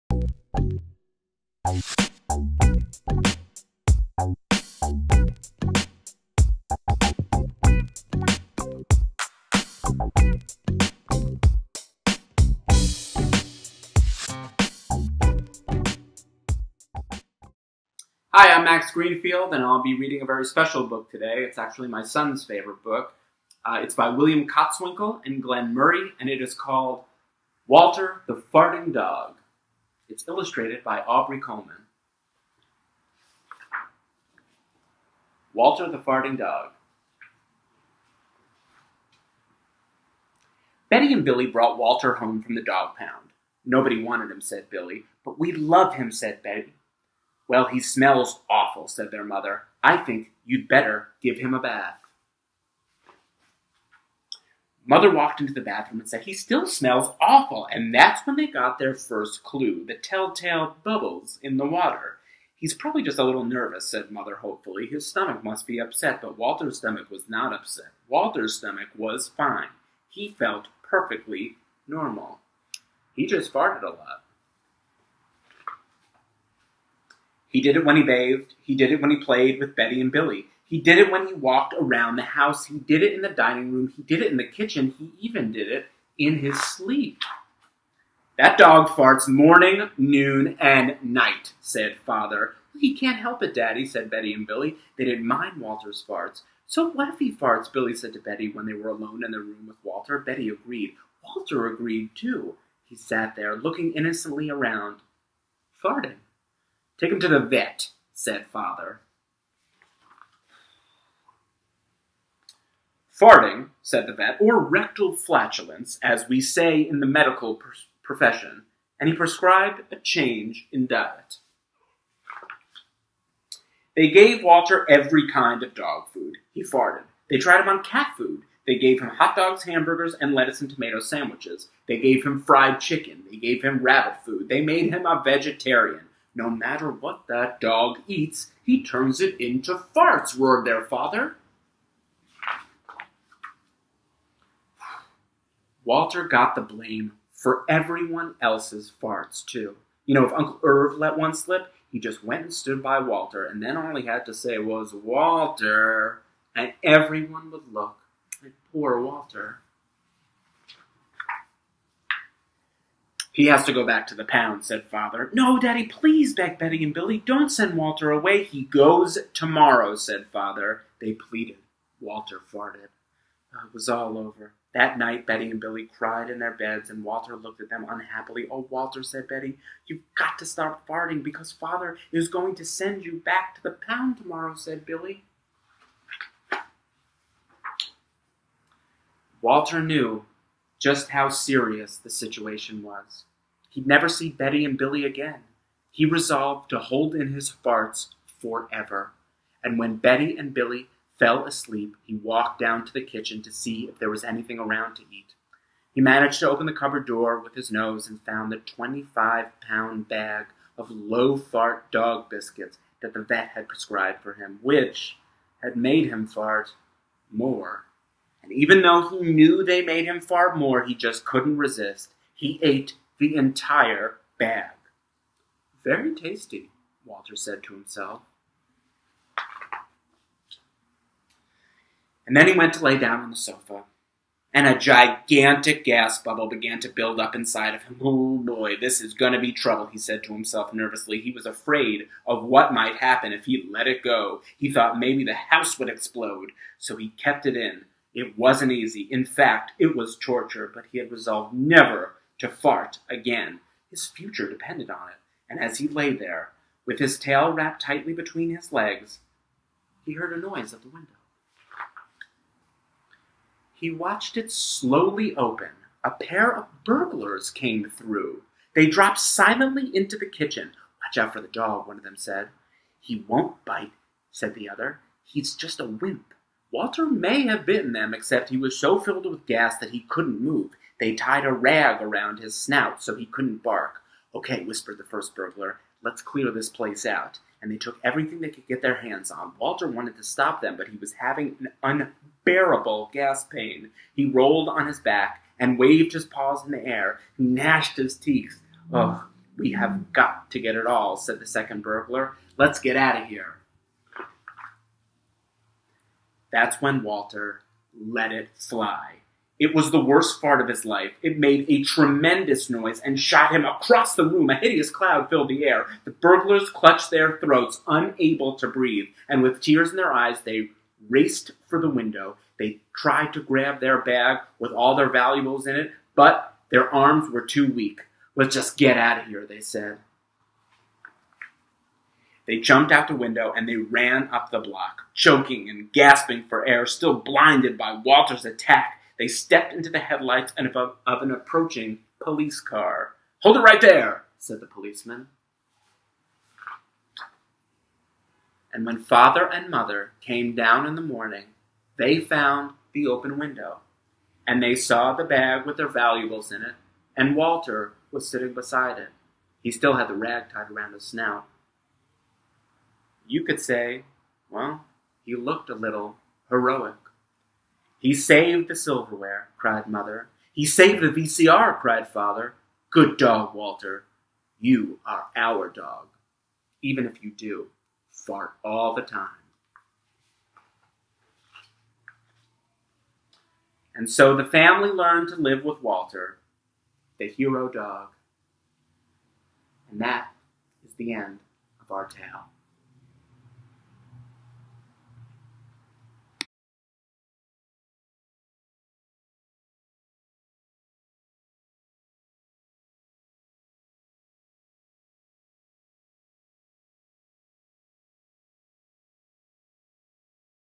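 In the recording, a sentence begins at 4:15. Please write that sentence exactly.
And as he lay there, with his tail wrapped tightly between his legs, he heard a noise at the window.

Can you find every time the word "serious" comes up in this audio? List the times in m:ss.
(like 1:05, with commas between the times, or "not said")
3:11.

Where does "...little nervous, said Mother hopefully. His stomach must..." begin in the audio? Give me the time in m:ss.
1:03.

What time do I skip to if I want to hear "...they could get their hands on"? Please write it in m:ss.
4:48.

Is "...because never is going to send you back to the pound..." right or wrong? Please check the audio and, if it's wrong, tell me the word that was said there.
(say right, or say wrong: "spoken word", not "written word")
wrong: "father", not "never".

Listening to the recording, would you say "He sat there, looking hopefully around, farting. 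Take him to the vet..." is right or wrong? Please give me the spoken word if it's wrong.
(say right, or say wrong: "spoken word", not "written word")
wrong: "innocently", not "hopefully".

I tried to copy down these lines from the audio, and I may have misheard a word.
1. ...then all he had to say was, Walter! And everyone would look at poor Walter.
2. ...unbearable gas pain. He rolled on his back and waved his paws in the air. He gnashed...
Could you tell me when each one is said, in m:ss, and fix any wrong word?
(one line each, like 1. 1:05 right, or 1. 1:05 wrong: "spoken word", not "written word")
1. 2:33 right
2. 4:52 right.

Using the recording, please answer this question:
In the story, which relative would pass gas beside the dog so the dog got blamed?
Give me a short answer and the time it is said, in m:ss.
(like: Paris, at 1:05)
Uncle Irv, at 2:30.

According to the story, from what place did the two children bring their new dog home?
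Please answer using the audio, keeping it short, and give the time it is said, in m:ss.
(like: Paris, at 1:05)
the dog pound, at 0:42.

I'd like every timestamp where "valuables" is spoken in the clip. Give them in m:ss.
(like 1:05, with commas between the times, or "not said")
5:25, 5:55.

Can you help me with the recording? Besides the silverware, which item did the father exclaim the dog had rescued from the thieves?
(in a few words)
VCR.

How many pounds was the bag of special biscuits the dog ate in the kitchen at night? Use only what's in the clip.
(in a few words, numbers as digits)
25.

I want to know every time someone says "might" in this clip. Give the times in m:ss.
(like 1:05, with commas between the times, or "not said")
4:02.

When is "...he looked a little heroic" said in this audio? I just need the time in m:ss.
6:05.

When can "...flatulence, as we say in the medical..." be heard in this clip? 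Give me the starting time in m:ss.
1:55.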